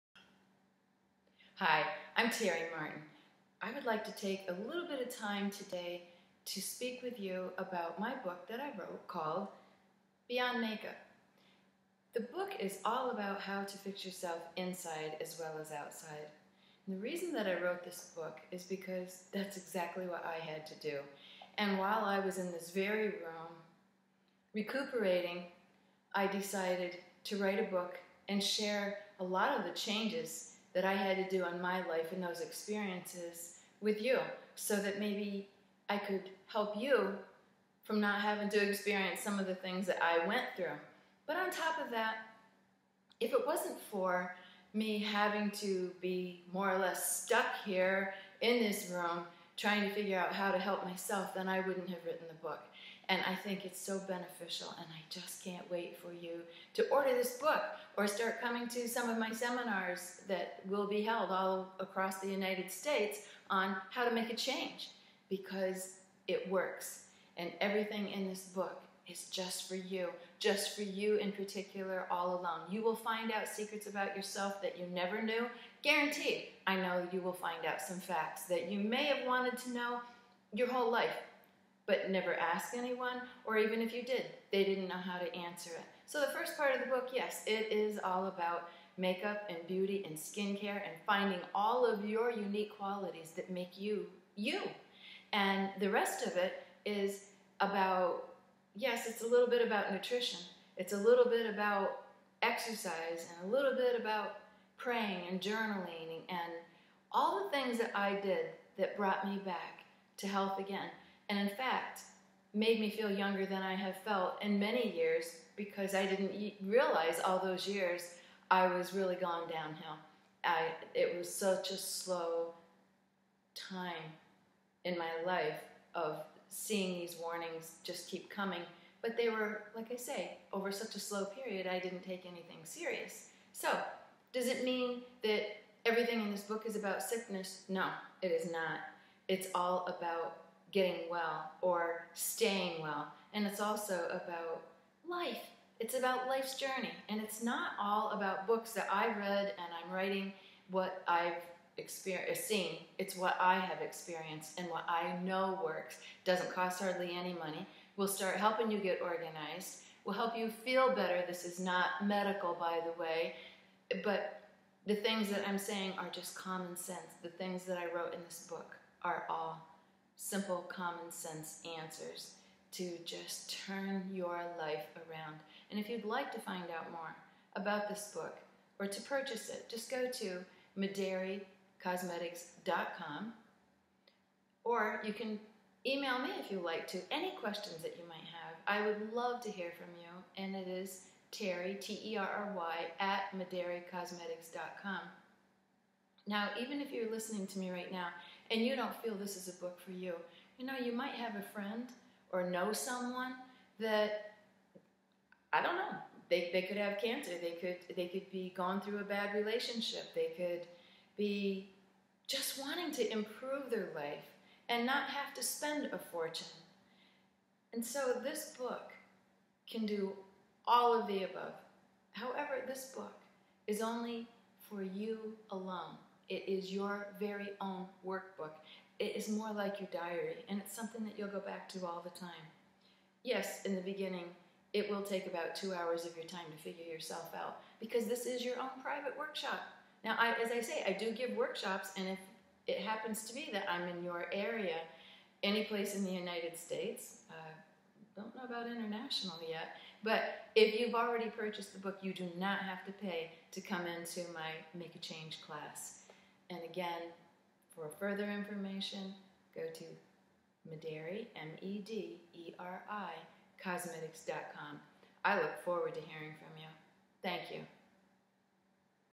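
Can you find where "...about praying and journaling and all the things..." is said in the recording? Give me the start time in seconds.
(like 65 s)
103 s.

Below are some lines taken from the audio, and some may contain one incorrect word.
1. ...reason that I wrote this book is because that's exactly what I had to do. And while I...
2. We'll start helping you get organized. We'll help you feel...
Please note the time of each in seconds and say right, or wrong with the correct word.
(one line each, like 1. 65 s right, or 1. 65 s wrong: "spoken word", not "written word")
1. 16 s right
2. 157 s right.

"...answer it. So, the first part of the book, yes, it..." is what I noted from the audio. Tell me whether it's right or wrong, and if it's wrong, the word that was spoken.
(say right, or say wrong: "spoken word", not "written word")
right.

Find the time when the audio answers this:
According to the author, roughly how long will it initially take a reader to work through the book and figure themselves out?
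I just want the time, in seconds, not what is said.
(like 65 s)
235 s.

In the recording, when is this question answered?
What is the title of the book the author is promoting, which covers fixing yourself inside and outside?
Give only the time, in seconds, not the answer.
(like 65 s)
10 s.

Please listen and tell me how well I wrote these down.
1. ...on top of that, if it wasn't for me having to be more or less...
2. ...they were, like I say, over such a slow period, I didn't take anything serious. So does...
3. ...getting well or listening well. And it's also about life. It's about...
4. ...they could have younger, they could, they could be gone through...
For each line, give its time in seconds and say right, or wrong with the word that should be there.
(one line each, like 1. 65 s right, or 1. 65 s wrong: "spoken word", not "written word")
1. 41 s right
2. 129 s right
3. 140 s wrong: "staying", not "listening"
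4. 206 s wrong: "cancer", not "younger".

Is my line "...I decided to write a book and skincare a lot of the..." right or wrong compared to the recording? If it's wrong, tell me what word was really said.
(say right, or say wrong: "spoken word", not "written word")
wrong: "share", not "skincare".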